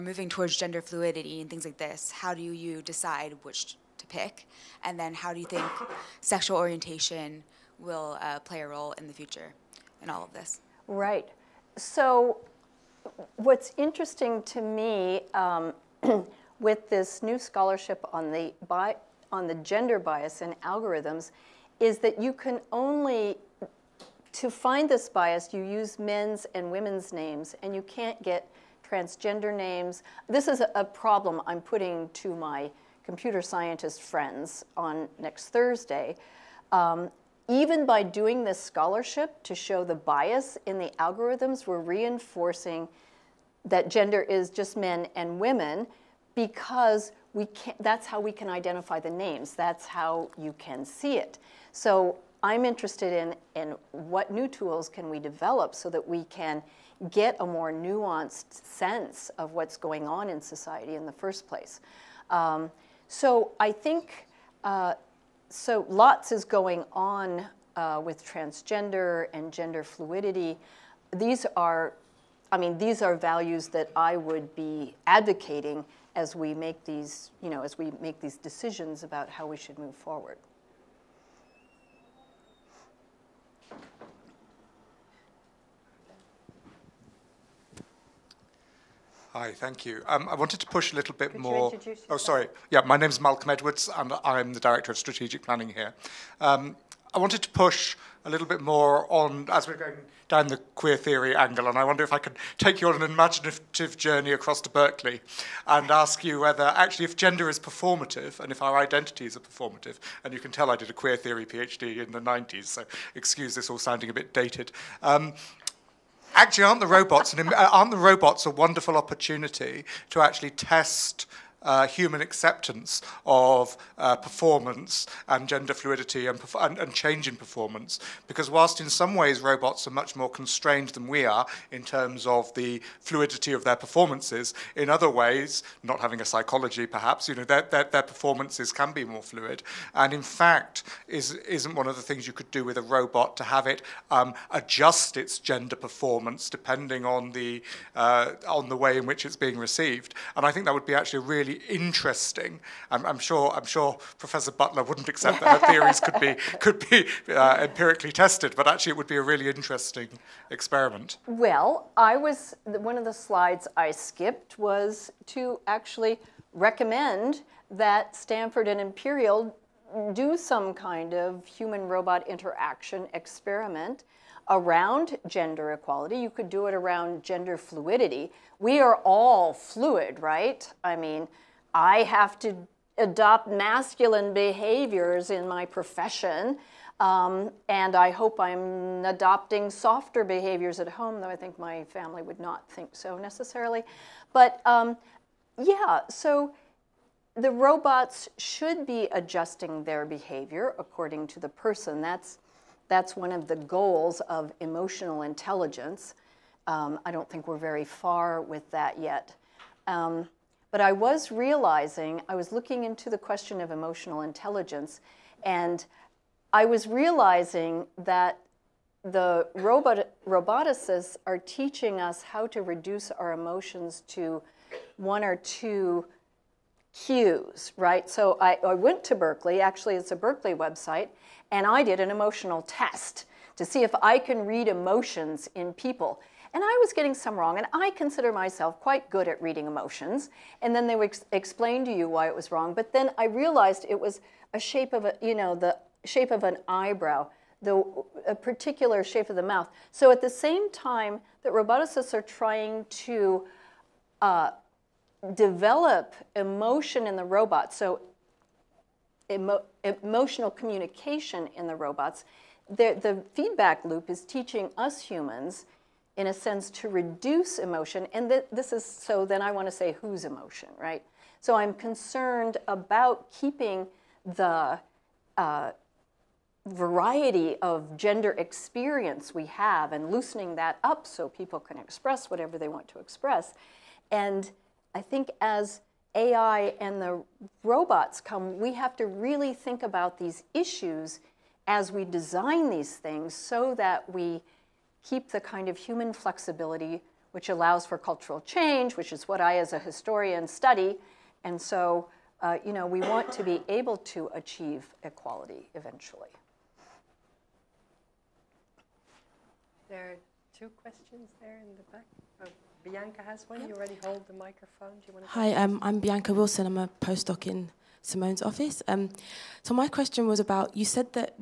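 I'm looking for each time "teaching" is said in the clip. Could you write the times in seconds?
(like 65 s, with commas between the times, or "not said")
221 s, 264 s.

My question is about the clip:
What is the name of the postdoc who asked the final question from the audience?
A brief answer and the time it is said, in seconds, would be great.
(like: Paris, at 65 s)
Bianca Wilson, at 315 s.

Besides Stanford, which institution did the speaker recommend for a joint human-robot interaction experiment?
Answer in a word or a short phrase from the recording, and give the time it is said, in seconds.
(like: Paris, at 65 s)
Imperial, at 168 s.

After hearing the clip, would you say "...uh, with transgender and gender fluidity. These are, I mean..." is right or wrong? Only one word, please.
right.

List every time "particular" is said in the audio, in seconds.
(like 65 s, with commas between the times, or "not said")
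248 s.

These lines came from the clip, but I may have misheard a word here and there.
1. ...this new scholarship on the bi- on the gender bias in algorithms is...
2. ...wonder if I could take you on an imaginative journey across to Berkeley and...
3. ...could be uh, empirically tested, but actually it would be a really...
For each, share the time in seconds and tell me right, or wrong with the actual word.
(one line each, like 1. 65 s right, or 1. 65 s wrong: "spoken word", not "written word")
1. 16 s right
2. 101 s right
3. 156 s right.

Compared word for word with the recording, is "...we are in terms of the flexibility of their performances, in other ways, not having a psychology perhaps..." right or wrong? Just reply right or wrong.
wrong.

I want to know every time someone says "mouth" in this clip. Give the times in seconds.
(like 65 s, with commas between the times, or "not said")
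249 s.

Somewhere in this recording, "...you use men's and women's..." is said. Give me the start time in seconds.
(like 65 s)
25 s.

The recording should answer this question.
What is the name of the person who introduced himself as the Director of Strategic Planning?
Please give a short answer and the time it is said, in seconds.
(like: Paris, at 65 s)
Malcolm Edwards, at 93 s.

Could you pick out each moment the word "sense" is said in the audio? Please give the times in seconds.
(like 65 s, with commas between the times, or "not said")
58 s, 266 s.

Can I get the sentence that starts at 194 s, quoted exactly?
But um, yeah, so the robots should be adjusting their behavior according to the person.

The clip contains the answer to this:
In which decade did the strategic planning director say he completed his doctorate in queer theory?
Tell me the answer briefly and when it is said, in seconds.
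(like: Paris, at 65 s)
the 90s, at 112 s.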